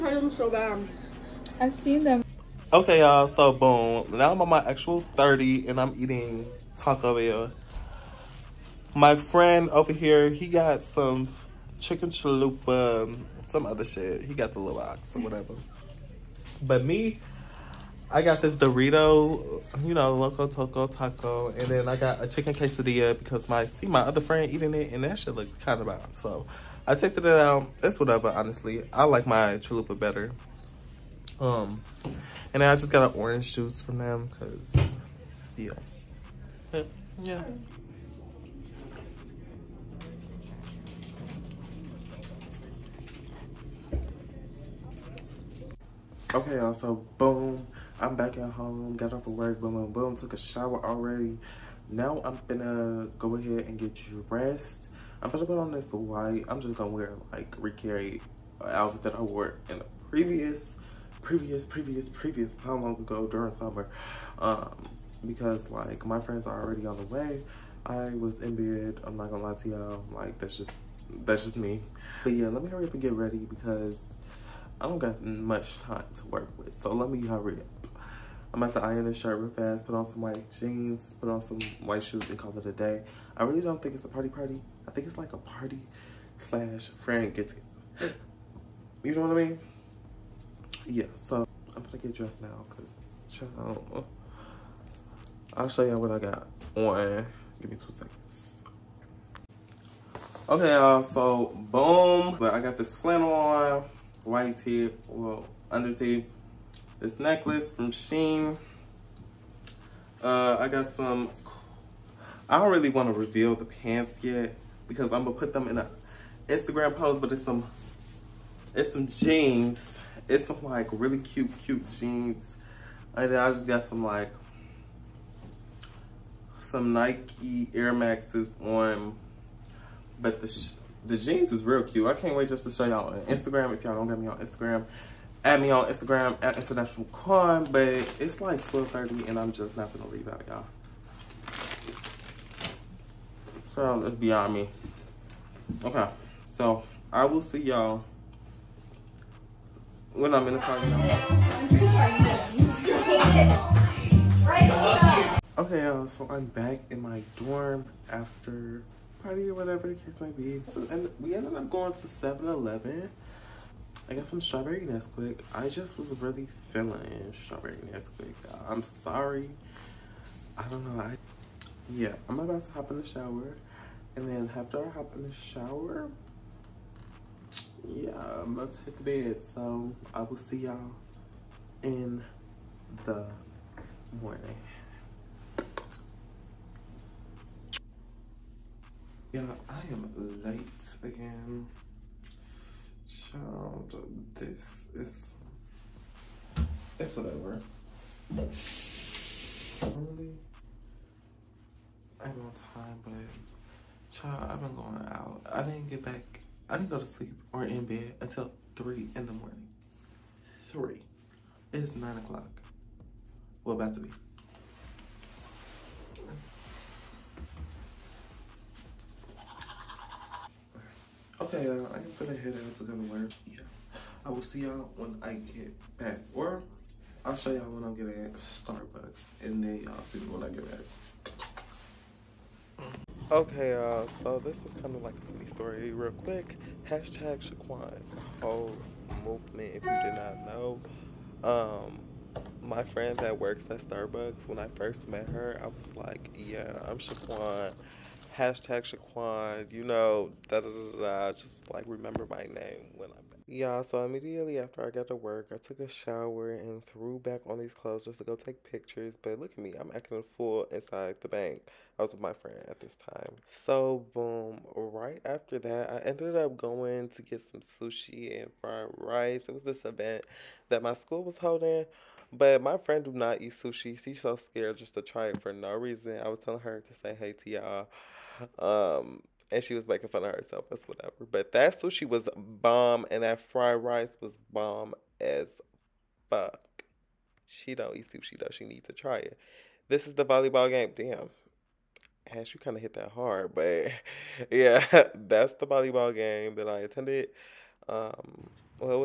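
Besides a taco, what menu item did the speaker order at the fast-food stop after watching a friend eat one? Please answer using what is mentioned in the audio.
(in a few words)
Chicken quesadilla.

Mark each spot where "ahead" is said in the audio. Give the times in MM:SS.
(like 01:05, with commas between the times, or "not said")
00:53.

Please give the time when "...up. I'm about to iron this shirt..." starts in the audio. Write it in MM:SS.
01:17.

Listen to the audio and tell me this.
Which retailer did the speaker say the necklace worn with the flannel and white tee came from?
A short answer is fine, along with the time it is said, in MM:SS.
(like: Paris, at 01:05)
Shein, at 01:47.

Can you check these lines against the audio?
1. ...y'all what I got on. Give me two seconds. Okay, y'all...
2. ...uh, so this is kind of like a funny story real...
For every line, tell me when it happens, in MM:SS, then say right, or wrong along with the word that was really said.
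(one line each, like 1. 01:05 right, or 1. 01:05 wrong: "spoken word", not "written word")
1. 01:35 right
2. 03:53 right.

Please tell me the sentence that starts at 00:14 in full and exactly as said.
He got the little box or whatever.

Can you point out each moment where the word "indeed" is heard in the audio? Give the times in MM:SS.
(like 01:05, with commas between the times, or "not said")
not said.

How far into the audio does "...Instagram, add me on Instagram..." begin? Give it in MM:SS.
02:14.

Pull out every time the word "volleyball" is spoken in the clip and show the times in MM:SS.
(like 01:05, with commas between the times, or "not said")
04:50, 04:55.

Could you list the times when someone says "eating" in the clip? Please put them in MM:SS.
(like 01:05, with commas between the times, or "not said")
00:05, 00:24.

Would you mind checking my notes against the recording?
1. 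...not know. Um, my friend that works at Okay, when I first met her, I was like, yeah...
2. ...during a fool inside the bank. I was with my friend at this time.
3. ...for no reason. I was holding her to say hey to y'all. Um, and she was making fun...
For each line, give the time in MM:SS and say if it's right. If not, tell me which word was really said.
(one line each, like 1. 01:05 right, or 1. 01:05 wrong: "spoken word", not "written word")
1. 04:00 wrong: "Starbucks", not "Okay"
2. 04:19 wrong: "acting", not "during"
3. 04:35 wrong: "telling", not "holding".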